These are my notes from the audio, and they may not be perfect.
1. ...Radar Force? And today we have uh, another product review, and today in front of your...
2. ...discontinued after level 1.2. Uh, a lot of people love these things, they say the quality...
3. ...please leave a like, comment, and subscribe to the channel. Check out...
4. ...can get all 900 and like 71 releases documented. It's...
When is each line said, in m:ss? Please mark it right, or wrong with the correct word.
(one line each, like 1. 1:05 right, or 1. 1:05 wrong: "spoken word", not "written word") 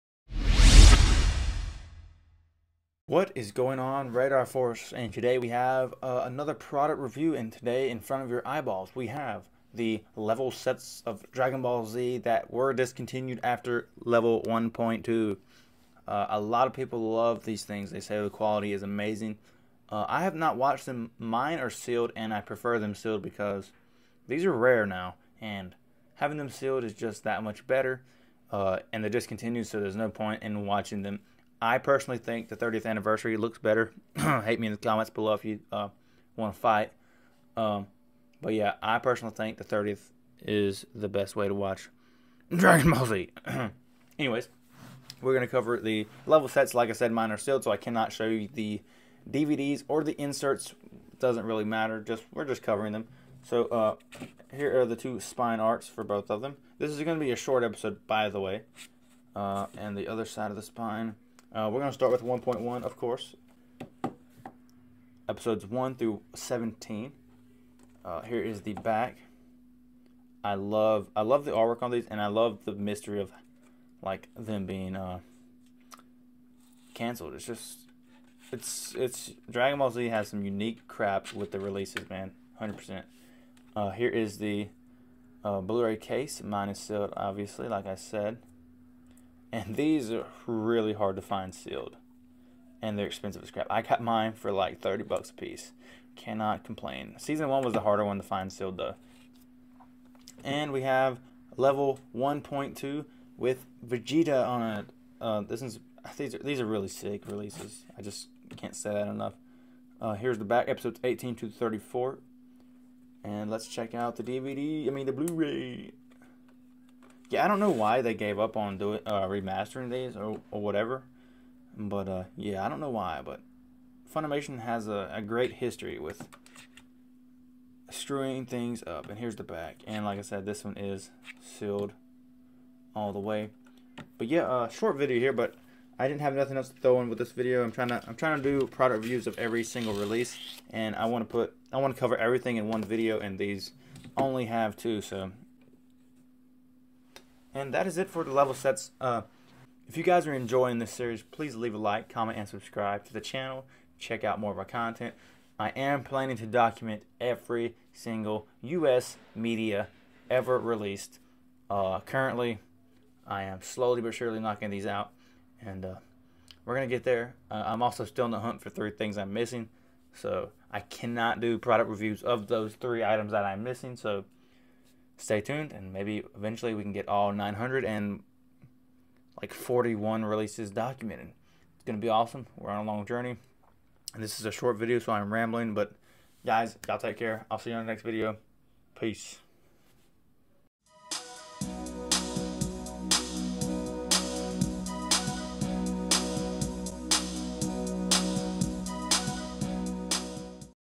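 1. 0:04 right
2. 0:12 right
3. 2:31 right
4. 2:56 wrong: "41", not "71".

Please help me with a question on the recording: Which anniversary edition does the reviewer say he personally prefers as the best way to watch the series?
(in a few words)
30th anniversary.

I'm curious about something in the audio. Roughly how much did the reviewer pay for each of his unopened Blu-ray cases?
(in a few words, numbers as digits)
$30.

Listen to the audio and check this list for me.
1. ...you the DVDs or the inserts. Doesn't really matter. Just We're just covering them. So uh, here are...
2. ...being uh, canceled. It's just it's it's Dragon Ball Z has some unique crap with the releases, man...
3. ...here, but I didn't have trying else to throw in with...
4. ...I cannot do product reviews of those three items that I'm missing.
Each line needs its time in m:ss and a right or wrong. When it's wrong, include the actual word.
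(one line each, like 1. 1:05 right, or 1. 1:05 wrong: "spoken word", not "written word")
1. 0:48 right
2. 1:14 right
3. 2:15 wrong: "nothing", not "trying"
4. 2:50 right.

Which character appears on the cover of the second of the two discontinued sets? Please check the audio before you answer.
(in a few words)
Vegeta.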